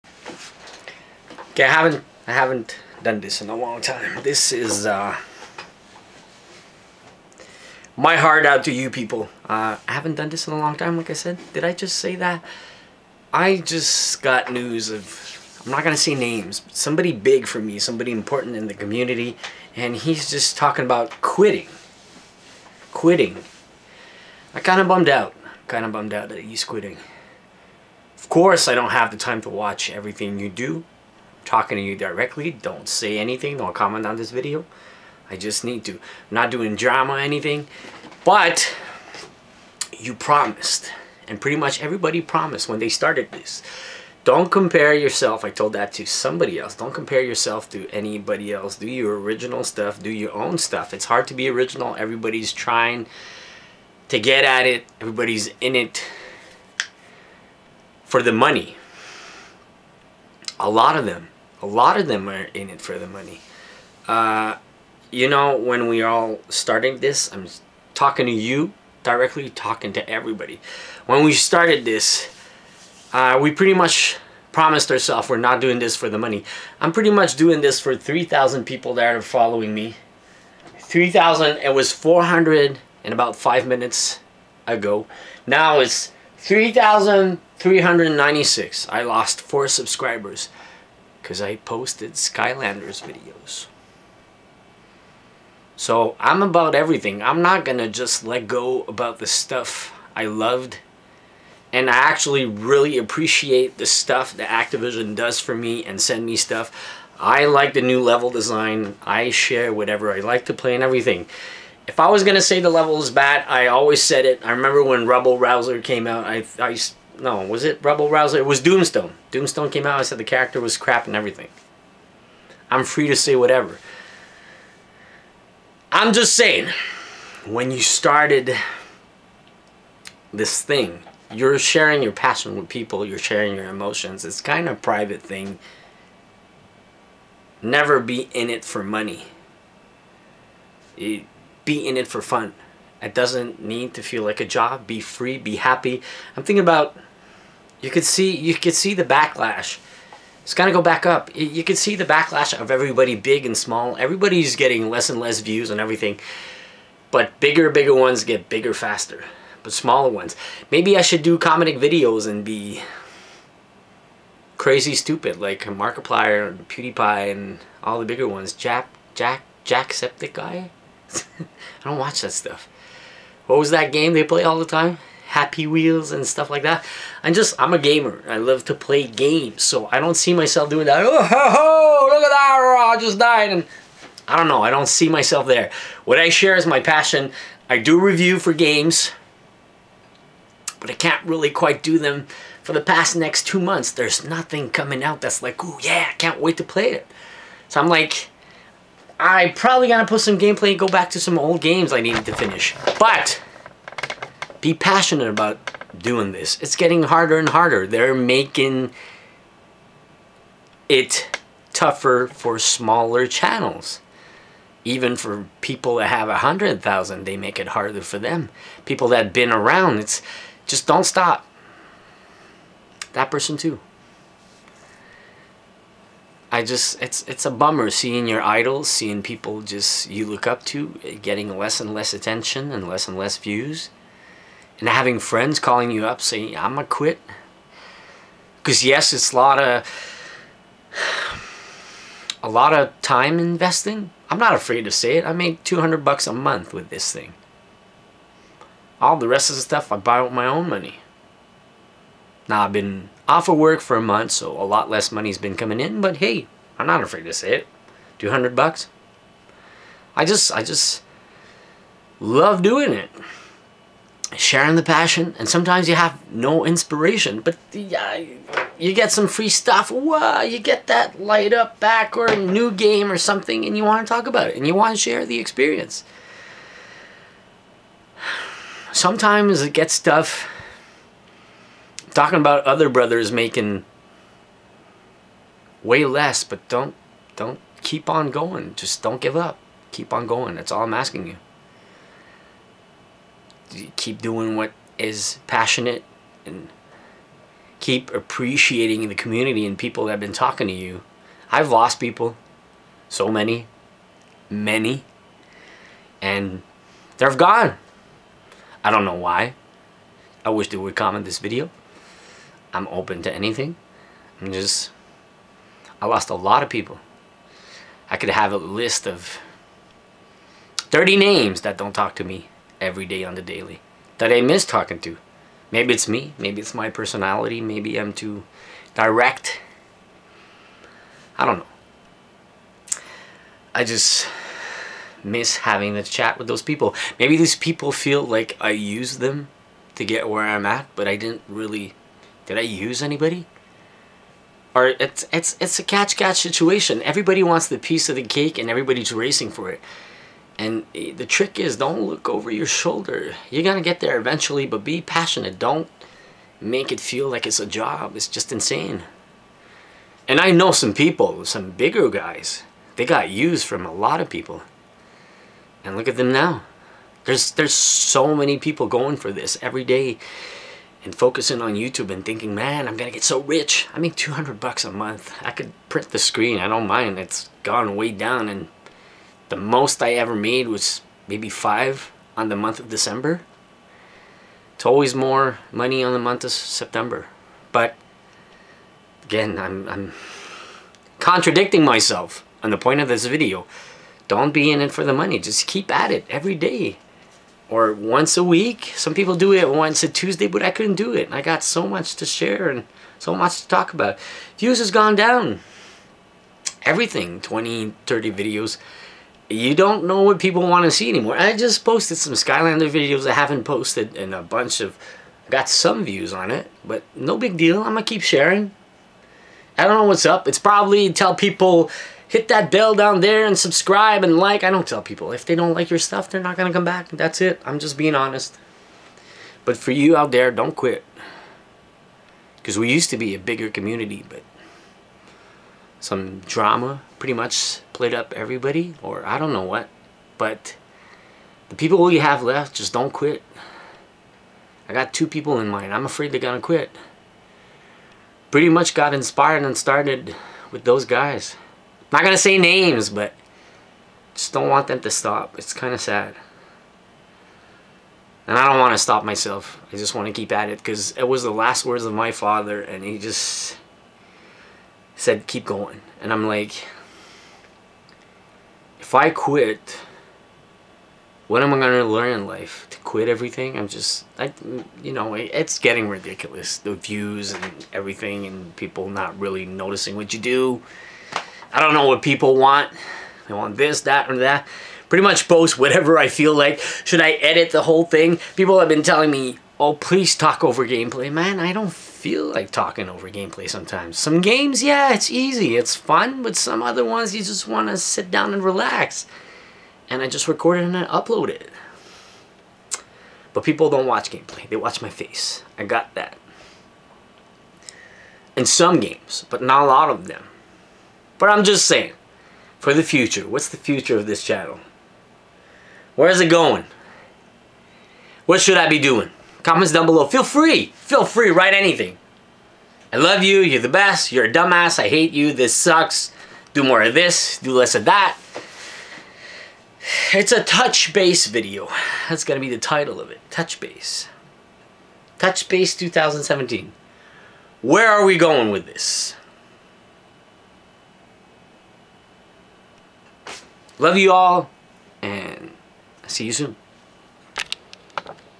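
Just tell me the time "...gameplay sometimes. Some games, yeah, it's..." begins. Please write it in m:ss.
8:13.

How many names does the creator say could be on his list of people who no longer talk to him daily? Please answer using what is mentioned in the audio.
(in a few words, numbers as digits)
30.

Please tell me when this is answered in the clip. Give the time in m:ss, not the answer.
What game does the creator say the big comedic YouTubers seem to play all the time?
2:55.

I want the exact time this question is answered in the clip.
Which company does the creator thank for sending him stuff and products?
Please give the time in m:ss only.
1:44.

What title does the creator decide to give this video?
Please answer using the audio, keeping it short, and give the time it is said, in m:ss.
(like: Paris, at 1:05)
Touch Base 2017, at 8:55.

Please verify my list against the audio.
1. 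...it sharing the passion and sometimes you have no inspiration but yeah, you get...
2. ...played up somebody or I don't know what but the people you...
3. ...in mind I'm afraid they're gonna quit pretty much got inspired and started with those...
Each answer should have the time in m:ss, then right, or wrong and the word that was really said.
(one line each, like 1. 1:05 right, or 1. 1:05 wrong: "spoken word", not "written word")
1. 4:22 right
2. 7:17 wrong: "everybody", not "somebody"
3. 7:25 right.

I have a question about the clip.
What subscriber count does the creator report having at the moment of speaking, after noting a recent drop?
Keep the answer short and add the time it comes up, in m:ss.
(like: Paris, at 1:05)
3,396, at 1:26.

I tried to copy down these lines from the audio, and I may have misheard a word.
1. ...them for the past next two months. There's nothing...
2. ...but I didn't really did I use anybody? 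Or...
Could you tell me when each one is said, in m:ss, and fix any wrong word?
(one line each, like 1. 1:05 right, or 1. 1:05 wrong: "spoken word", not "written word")
1. 3:11 right
2. 5:40 right.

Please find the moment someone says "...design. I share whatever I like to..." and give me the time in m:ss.
1:48.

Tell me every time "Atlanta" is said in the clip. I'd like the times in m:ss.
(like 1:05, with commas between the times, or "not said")
not said.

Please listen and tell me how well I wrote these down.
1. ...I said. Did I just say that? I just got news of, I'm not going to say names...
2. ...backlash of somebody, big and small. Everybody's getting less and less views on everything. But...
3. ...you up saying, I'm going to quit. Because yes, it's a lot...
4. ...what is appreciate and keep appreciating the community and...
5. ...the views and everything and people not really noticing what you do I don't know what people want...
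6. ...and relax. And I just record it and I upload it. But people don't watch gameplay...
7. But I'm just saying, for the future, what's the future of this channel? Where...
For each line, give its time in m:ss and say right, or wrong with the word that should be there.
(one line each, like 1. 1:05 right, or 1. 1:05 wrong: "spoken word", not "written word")
1. 0:11 right
2. 2:32 wrong: "everybody", not "somebody"
3. 3:55 right
4. 4:54 wrong: "passionate", not "appreciate"
5. 7:56 right
6. 8:18 right
7. 8:31 right.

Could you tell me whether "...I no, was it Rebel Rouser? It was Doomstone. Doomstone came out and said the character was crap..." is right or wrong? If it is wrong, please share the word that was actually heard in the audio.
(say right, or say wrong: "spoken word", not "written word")
right.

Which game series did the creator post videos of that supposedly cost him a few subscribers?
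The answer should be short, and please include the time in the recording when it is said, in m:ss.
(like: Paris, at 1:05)
Skylanders, at 1:32.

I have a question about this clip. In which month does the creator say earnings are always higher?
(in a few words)
September.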